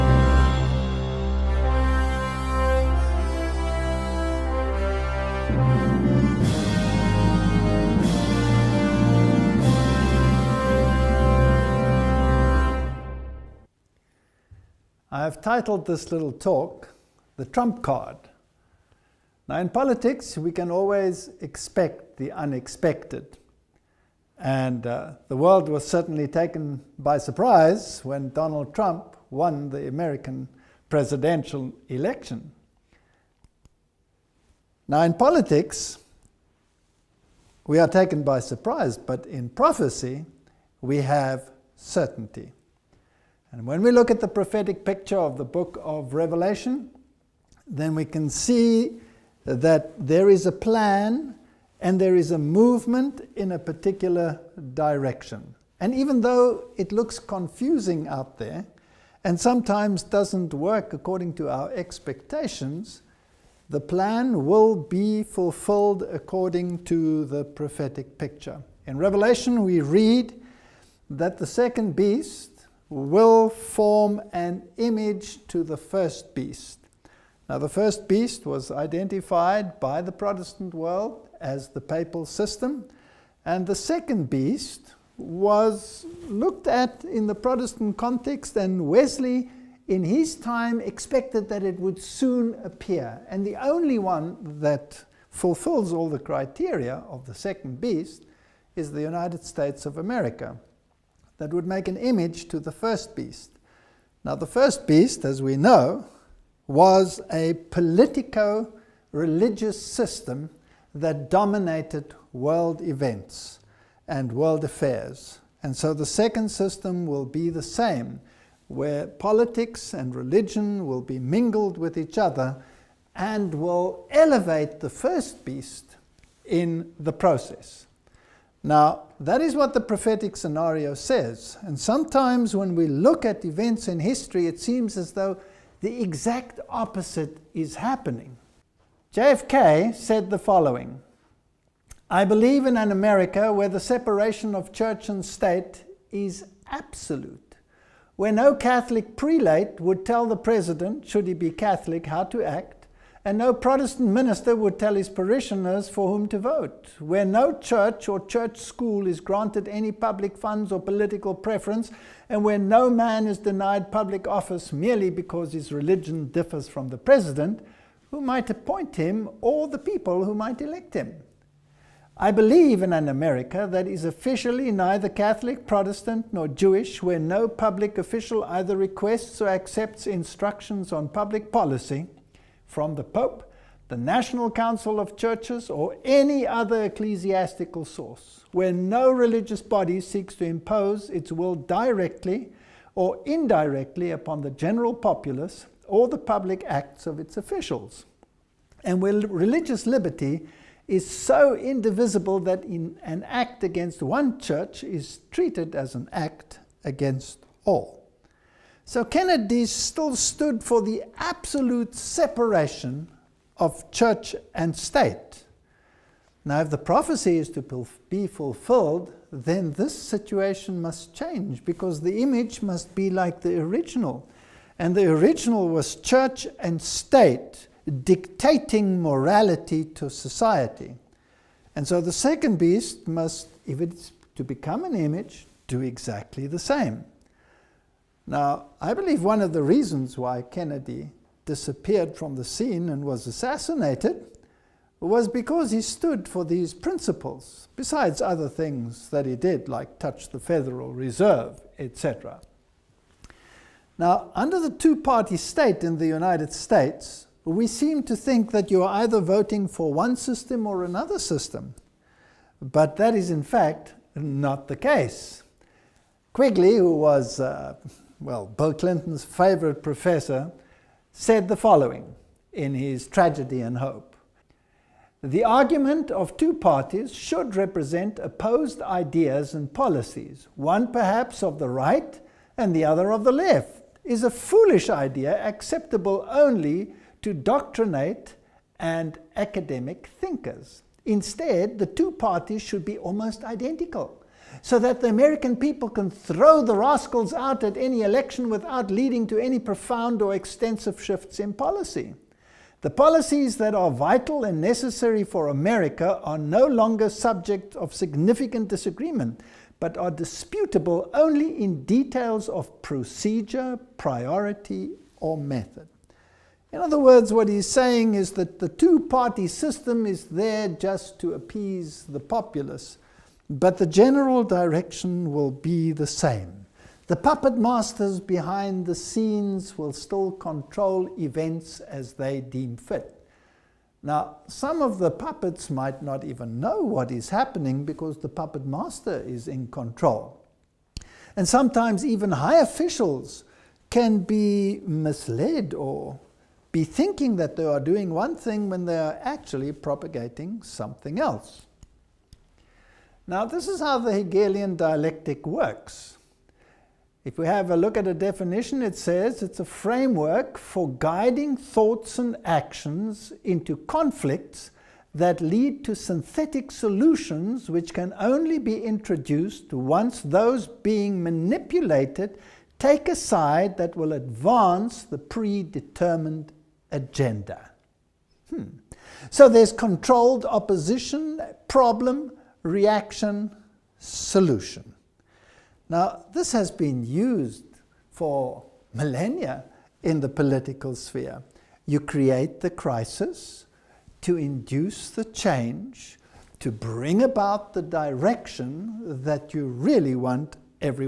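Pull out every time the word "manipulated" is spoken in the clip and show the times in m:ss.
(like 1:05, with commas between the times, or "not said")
6:11.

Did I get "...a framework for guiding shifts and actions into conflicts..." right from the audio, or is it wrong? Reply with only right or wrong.
wrong.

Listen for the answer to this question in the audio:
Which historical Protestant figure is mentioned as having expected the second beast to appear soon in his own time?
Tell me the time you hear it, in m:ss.
1:28.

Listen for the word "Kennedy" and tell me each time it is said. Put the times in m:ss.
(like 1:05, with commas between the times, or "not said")
3:29, 4:00.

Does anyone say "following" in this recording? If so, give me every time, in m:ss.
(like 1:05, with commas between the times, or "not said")
2:20, 4:31.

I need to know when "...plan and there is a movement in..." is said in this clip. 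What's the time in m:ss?
0:50.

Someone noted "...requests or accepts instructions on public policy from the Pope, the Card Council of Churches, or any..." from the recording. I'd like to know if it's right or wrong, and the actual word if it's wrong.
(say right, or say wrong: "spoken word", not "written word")
wrong: "National", not "Card".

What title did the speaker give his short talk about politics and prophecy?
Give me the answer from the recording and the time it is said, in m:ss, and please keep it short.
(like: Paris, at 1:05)
The Trump Card, at 0:17.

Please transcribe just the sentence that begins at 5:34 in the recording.
Now, some of the puppets might not even know what is happening because the puppet master is in control.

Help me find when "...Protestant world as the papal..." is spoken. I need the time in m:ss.
1:20.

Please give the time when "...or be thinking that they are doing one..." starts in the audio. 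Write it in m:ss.
5:45.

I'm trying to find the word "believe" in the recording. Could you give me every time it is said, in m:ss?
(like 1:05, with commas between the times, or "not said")
2:22, 2:52, 3:58.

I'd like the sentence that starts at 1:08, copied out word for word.
In Revelation, we read that the second beast, will form an image to the first beast.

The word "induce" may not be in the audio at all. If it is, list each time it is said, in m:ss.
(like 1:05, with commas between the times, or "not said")
6:34.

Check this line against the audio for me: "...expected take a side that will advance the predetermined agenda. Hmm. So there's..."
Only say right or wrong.
wrong.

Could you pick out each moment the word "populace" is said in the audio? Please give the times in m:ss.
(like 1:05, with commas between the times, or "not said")
3:14, 5:22.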